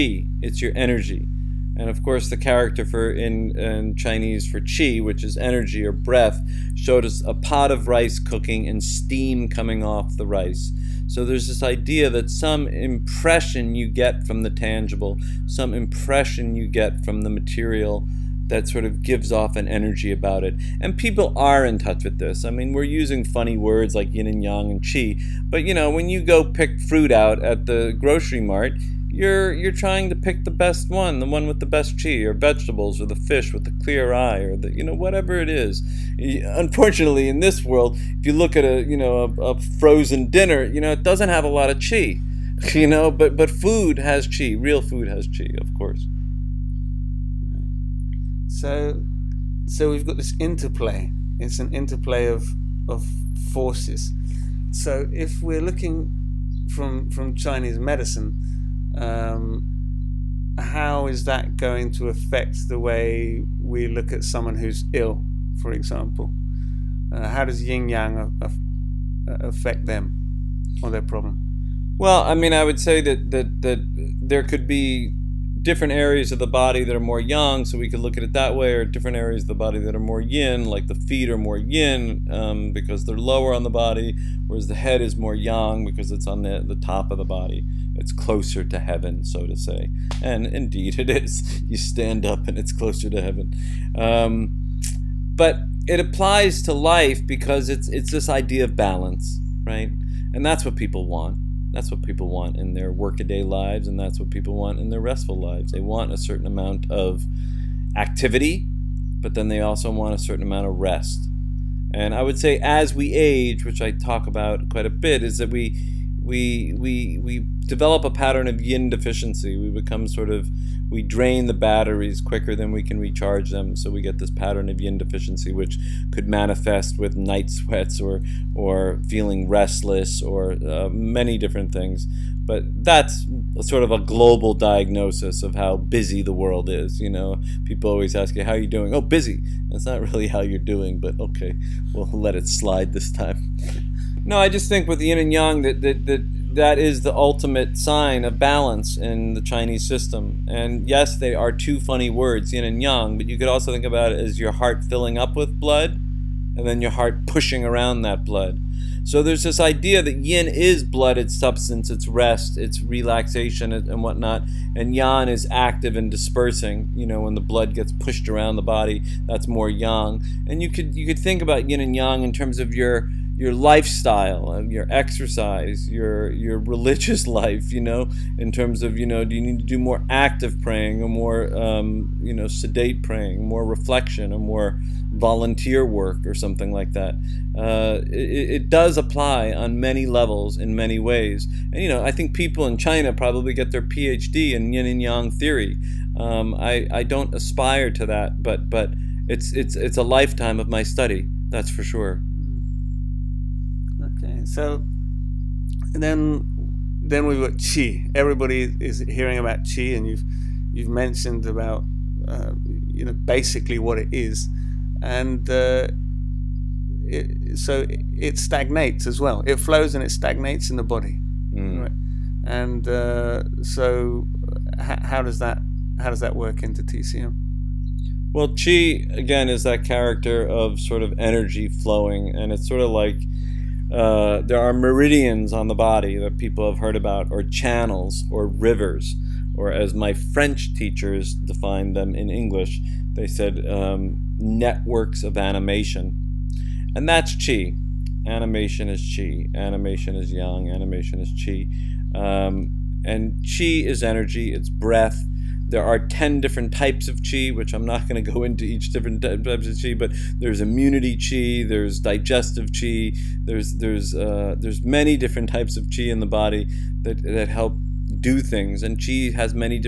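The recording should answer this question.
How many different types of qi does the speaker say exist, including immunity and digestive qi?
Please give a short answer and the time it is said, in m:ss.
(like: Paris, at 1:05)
10, at 4:15.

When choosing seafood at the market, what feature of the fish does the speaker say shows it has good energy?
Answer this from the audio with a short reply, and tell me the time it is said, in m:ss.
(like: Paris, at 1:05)
clear eye, at 0:33.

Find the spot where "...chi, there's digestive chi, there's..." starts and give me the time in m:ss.
4:21.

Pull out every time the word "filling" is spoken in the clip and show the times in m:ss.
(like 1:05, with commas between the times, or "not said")
2:34.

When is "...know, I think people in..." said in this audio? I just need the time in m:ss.
3:11.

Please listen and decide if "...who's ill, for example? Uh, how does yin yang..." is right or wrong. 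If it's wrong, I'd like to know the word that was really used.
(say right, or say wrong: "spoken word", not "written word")
right.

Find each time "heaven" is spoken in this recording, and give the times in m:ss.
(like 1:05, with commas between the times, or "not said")
1:28, 1:33.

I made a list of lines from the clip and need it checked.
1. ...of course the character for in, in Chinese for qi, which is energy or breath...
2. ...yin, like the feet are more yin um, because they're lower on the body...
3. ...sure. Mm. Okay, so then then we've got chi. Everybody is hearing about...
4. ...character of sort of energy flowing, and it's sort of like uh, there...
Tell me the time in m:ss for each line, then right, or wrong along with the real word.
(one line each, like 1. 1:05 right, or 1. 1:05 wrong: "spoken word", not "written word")
1. 0:01 right
2. 1:20 right
3. 3:21 right
4. 3:49 right.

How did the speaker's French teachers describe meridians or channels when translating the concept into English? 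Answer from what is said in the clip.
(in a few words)
networks of animation.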